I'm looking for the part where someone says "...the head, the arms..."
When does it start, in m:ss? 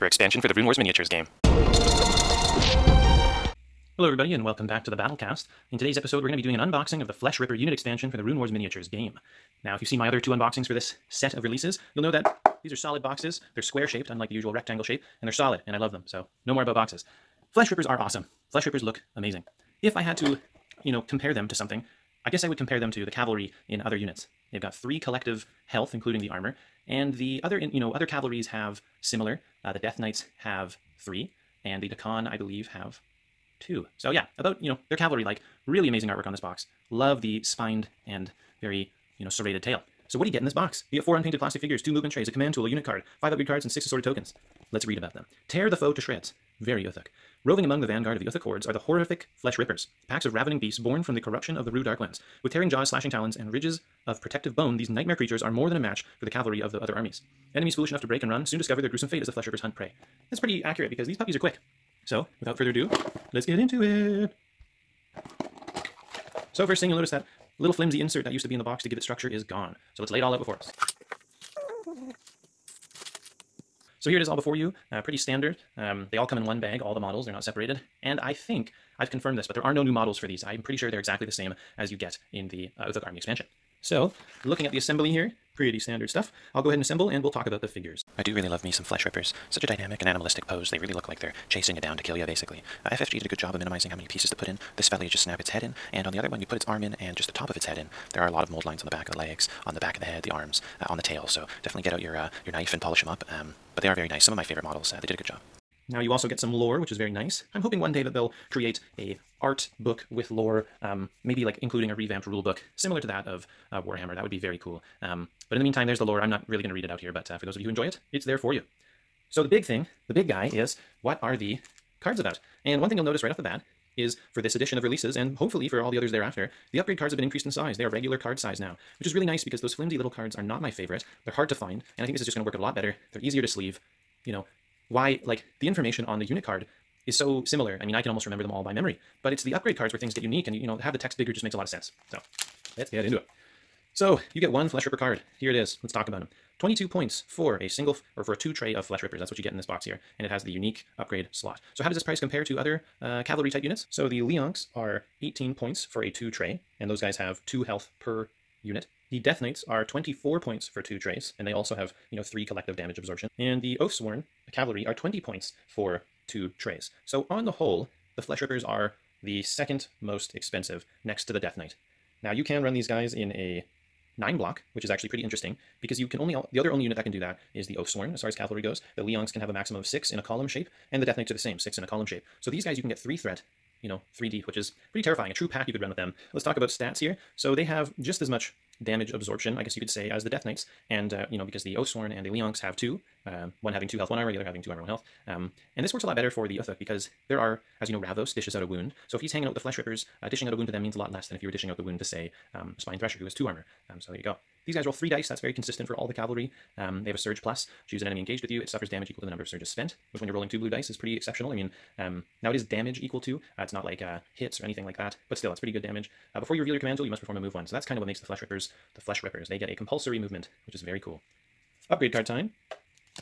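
1:40.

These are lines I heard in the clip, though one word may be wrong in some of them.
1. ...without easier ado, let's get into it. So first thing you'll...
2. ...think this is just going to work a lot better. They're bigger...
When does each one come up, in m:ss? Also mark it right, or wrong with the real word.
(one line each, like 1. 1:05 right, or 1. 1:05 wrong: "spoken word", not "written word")
1. 1:02 wrong: "further", not "easier"
2. 2:12 wrong: "easier", not "bigger".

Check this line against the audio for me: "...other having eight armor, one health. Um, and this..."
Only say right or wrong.
wrong.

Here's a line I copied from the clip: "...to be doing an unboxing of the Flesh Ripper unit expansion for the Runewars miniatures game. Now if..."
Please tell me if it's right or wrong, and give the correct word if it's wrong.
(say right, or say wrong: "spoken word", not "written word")
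right.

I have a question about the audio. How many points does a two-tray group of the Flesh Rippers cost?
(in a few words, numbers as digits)
22.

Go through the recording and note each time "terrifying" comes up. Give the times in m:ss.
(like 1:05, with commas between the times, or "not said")
3:05.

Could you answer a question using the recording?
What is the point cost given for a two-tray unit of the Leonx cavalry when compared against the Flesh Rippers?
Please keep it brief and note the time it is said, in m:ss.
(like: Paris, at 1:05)
18, at 2:35.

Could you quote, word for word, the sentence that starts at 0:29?
Uh, the Death Knights have three, and the Daqan, I believe, have two.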